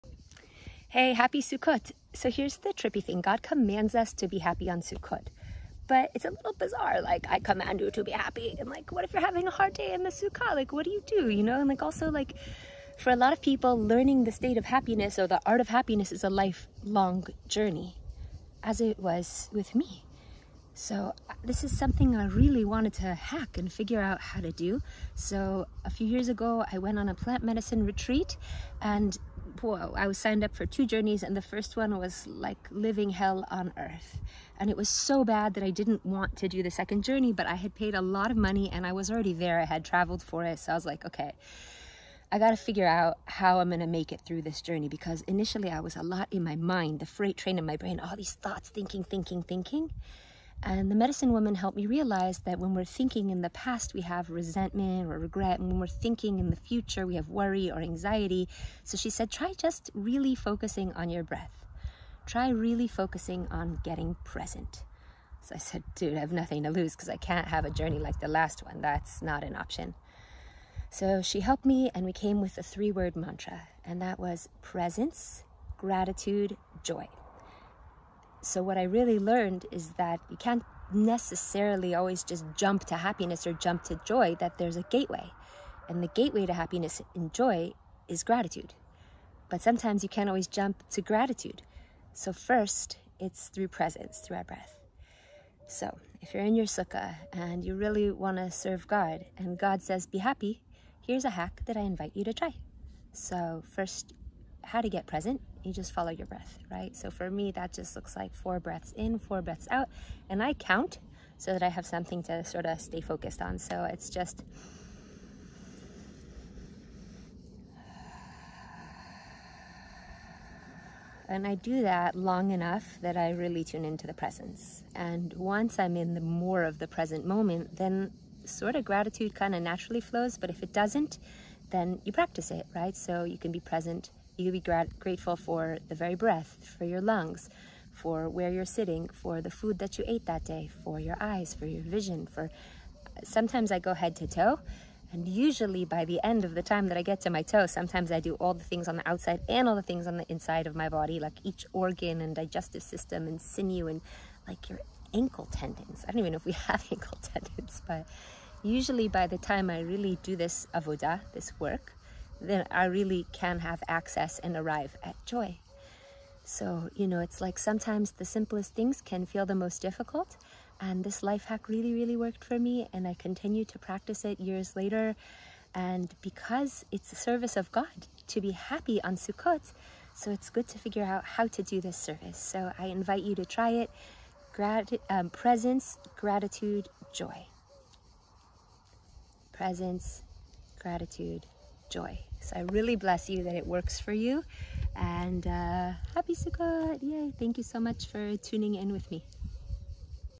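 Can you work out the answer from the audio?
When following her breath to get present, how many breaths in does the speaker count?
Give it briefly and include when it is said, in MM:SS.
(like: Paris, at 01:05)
4, at 01:48.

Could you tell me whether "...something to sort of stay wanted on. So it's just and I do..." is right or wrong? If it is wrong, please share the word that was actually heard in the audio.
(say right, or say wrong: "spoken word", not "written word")
wrong: "focused", not "wanted".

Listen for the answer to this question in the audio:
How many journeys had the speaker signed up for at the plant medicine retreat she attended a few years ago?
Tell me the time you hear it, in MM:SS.
00:30.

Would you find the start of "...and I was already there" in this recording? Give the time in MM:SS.
00:38.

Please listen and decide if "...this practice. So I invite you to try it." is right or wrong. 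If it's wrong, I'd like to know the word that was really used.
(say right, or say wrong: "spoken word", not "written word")
wrong: "service", not "practice".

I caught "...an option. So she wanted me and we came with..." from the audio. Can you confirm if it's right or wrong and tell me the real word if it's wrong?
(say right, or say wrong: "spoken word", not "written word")
wrong: "helped", not "wanted".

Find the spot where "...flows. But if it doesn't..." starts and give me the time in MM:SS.
02:10.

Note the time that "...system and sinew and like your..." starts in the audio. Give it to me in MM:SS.
02:32.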